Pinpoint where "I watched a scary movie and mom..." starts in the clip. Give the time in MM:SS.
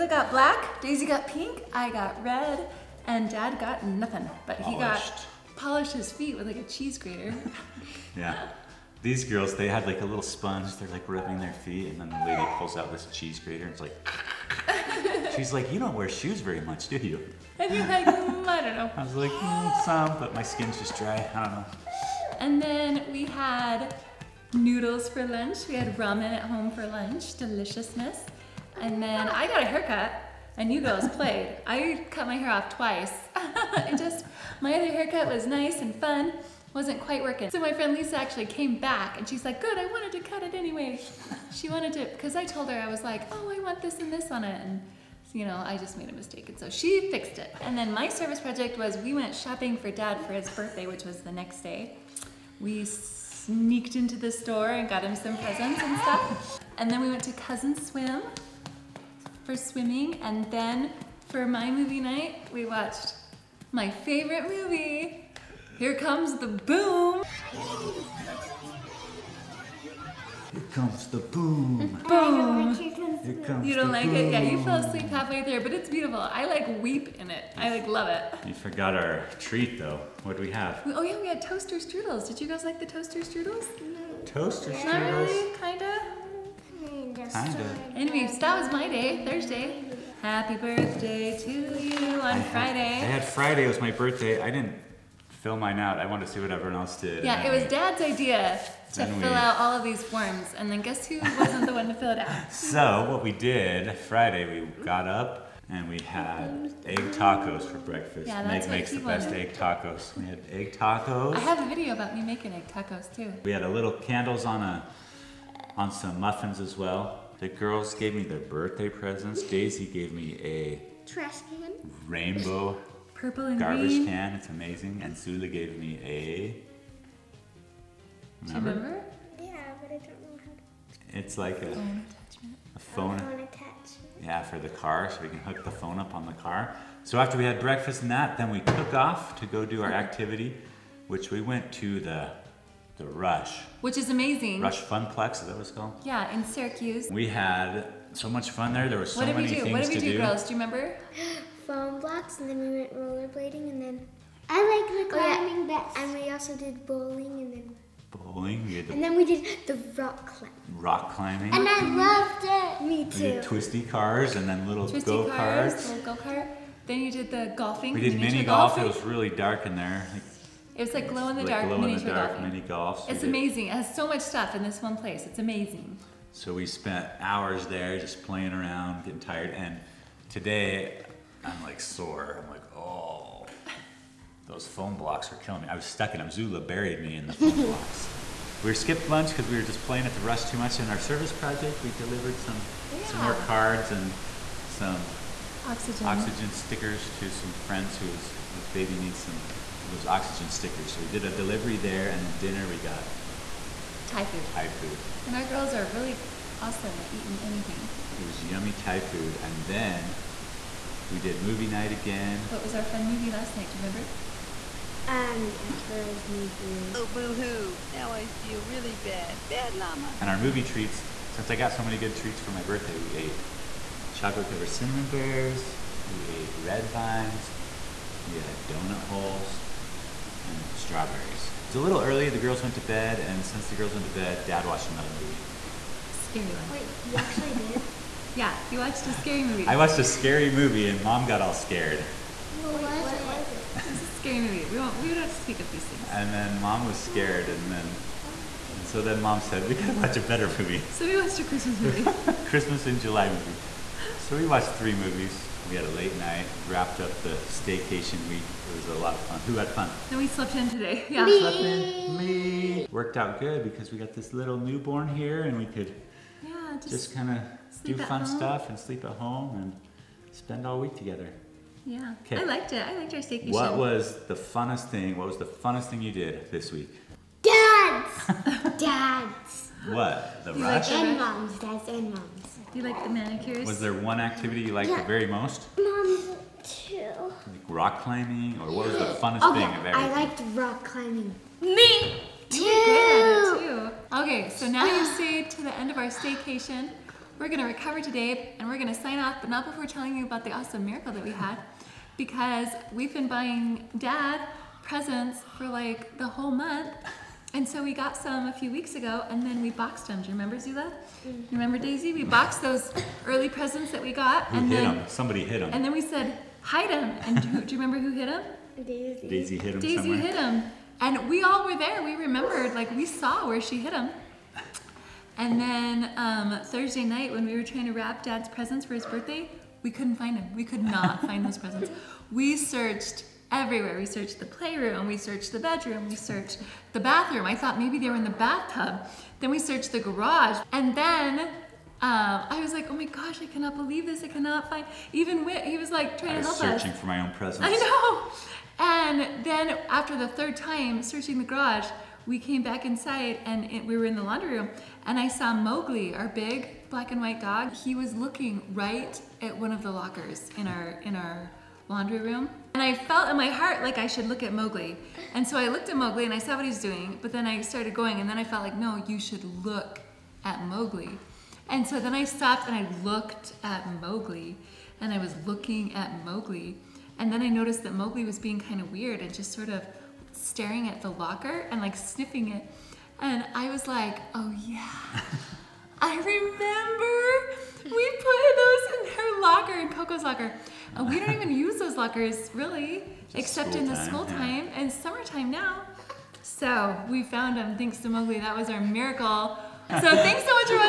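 03:59.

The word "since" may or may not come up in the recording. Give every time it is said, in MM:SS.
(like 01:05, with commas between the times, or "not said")
03:41, 03:53.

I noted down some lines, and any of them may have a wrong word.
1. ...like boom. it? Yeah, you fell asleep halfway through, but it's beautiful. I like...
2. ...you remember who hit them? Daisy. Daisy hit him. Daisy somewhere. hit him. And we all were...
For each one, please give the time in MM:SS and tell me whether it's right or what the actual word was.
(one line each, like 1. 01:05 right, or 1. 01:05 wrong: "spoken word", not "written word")
1. 01:13 right
2. 05:17 right.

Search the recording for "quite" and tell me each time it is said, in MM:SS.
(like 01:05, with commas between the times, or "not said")
00:36.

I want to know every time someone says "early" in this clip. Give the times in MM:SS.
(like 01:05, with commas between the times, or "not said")
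03:52, 05:13.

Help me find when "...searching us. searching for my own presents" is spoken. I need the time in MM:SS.
05:46.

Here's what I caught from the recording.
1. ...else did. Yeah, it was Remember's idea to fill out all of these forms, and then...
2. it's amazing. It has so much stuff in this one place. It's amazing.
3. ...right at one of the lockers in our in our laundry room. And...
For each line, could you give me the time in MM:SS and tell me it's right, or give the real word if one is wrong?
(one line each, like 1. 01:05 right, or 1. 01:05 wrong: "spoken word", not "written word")
1. 01:36 wrong: "Dad", not "Remember"
2. 02:53 right
3. 05:58 right.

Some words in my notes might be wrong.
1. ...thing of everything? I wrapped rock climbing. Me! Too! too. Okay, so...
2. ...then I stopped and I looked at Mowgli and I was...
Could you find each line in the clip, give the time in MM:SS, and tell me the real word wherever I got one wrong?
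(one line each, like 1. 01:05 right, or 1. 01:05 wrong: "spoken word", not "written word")
1. 04:49 wrong: "liked", not "wrapped"
2. 06:11 right.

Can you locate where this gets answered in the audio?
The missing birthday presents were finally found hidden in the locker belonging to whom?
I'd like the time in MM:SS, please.
06:29.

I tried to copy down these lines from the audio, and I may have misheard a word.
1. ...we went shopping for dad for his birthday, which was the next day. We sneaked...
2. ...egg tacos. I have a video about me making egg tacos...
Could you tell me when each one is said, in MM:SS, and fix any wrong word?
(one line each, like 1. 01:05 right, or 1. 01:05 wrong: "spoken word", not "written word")
1. 00:48 right
2. 01:50 right.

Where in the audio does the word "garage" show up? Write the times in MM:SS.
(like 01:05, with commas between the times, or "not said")
05:39, 05:51.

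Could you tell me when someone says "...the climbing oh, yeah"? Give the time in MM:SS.
02:35.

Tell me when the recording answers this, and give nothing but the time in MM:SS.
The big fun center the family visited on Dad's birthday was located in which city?
02:26.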